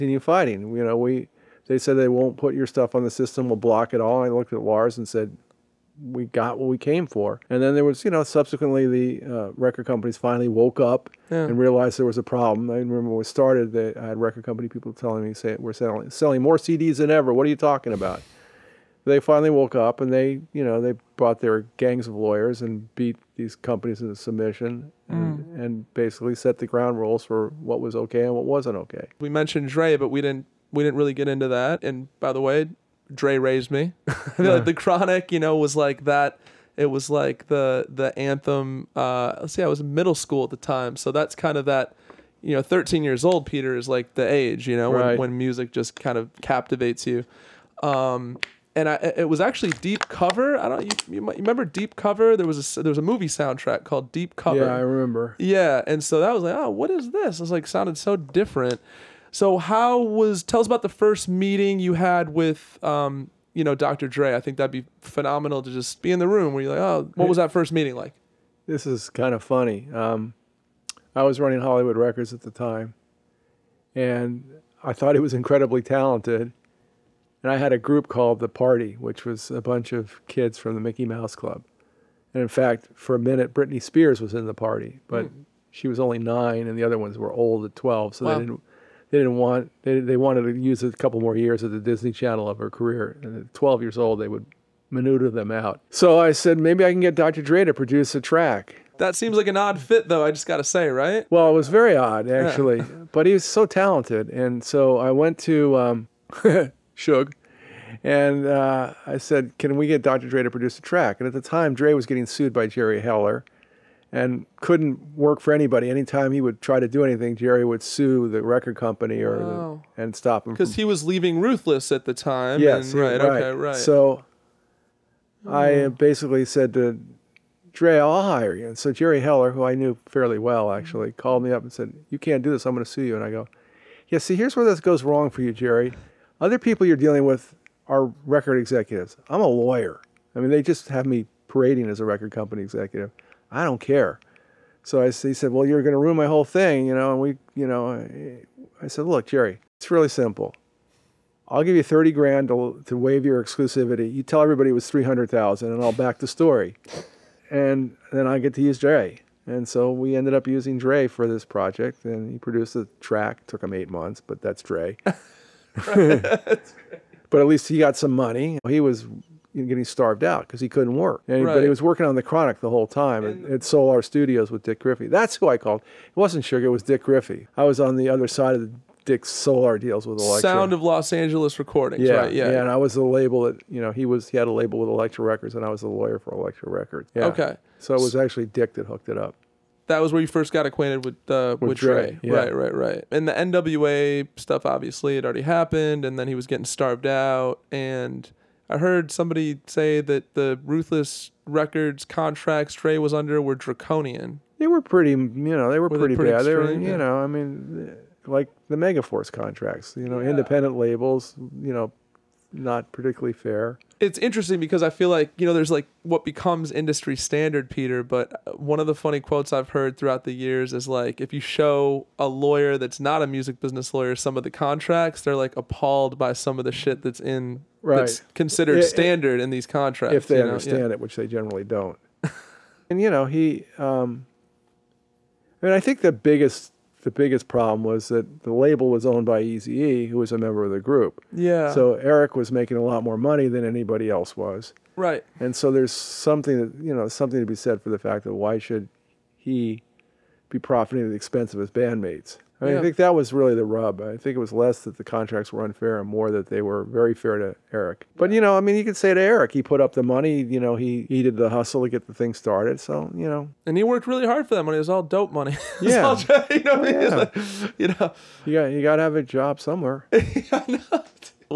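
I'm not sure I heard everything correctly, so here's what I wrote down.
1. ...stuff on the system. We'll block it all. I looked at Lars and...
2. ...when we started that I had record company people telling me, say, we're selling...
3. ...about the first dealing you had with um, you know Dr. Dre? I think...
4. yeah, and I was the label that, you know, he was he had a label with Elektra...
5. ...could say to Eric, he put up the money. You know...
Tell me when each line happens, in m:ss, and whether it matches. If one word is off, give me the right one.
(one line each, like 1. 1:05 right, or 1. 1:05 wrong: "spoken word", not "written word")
1. 0:02 right
2. 0:13 right
3. 1:00 wrong: "meeting", not "dealing"
4. 3:02 right
5. 4:18 right.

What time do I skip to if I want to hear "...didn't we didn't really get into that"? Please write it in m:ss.
0:30.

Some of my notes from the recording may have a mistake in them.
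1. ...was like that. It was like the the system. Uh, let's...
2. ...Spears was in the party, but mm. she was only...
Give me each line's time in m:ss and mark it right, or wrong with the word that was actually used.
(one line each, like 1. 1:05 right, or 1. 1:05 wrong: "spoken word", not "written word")
1. 0:35 wrong: "anthem", not "system"
2. 1:23 right.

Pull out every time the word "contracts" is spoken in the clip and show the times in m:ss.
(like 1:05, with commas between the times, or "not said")
3:22, 3:29, 3:44, 3:49, 4:15.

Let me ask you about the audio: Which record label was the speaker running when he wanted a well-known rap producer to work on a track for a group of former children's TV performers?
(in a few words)
Hollywood Records.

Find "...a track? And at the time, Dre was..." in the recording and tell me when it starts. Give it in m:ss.
1:50.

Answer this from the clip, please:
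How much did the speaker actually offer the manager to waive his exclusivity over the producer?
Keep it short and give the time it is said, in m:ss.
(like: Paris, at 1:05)
30 grand, at 2:31.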